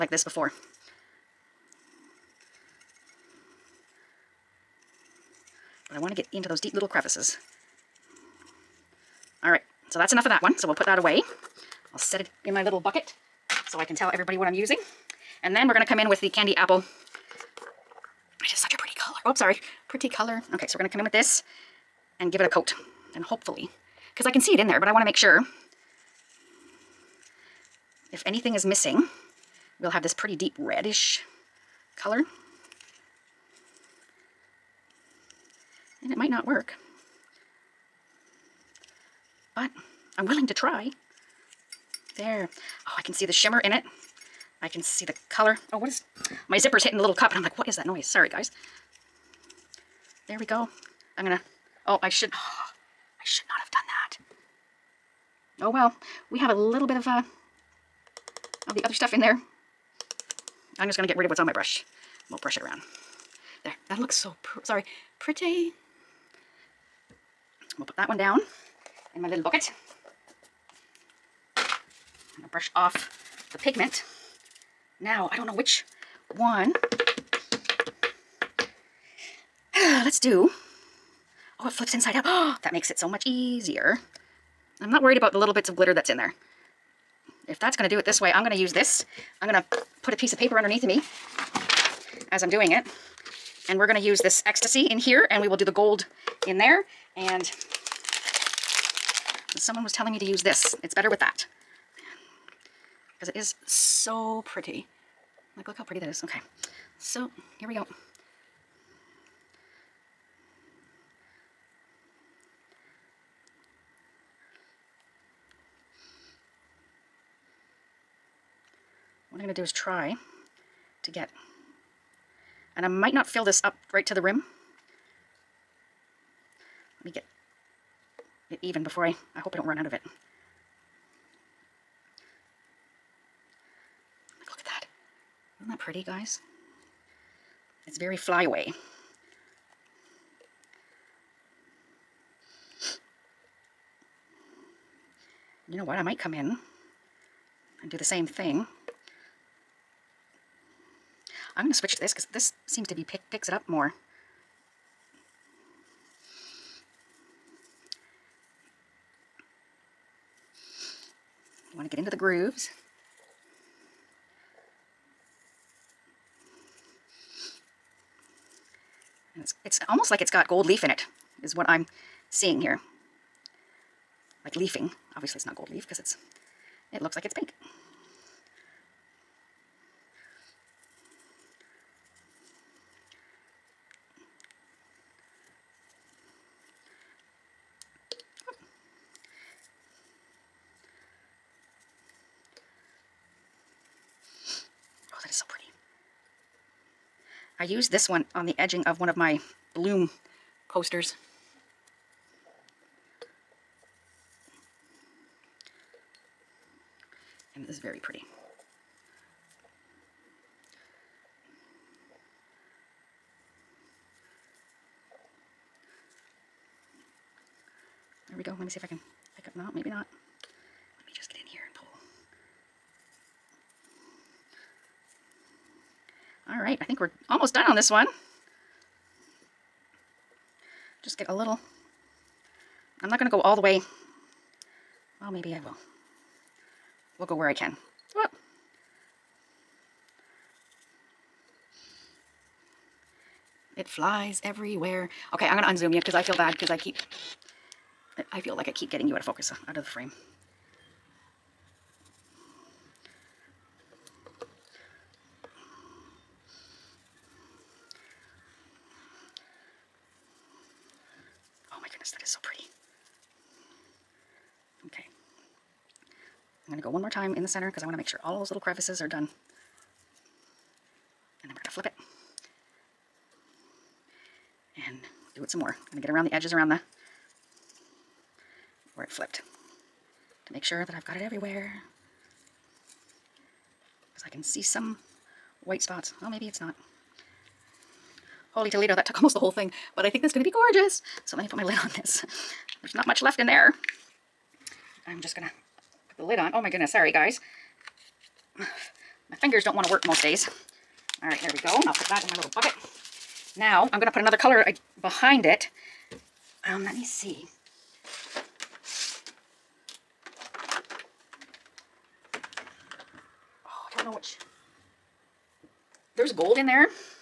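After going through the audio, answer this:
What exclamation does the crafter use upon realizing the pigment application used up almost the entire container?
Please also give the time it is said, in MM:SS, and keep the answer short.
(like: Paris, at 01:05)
Holy Toledo, at 04:48.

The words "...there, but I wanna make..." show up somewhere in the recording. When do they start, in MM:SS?
00:24.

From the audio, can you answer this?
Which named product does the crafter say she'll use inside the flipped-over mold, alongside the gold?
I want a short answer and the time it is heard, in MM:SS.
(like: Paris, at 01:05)
Ecstasy, at 01:34.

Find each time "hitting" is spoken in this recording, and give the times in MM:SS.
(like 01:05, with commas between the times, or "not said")
00:46.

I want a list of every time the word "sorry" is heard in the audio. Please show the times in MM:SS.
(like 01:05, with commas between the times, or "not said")
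00:19, 00:48, 01:04, 04:56.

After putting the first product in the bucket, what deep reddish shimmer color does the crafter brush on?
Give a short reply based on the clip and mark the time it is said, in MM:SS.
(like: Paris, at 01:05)
Candy apple, at 00:16.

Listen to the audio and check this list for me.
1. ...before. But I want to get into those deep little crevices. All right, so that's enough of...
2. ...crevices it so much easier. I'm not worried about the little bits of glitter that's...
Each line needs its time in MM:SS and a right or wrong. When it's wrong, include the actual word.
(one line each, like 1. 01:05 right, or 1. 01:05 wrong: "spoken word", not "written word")
1. 00:00 right
2. 01:22 wrong: "makes", not "crevices".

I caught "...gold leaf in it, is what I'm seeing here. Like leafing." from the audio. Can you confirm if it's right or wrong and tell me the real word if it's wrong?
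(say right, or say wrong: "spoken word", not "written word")
right.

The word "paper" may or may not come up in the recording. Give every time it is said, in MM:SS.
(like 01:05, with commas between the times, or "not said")
01:30.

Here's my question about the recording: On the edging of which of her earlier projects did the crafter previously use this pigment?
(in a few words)
Bloom posters.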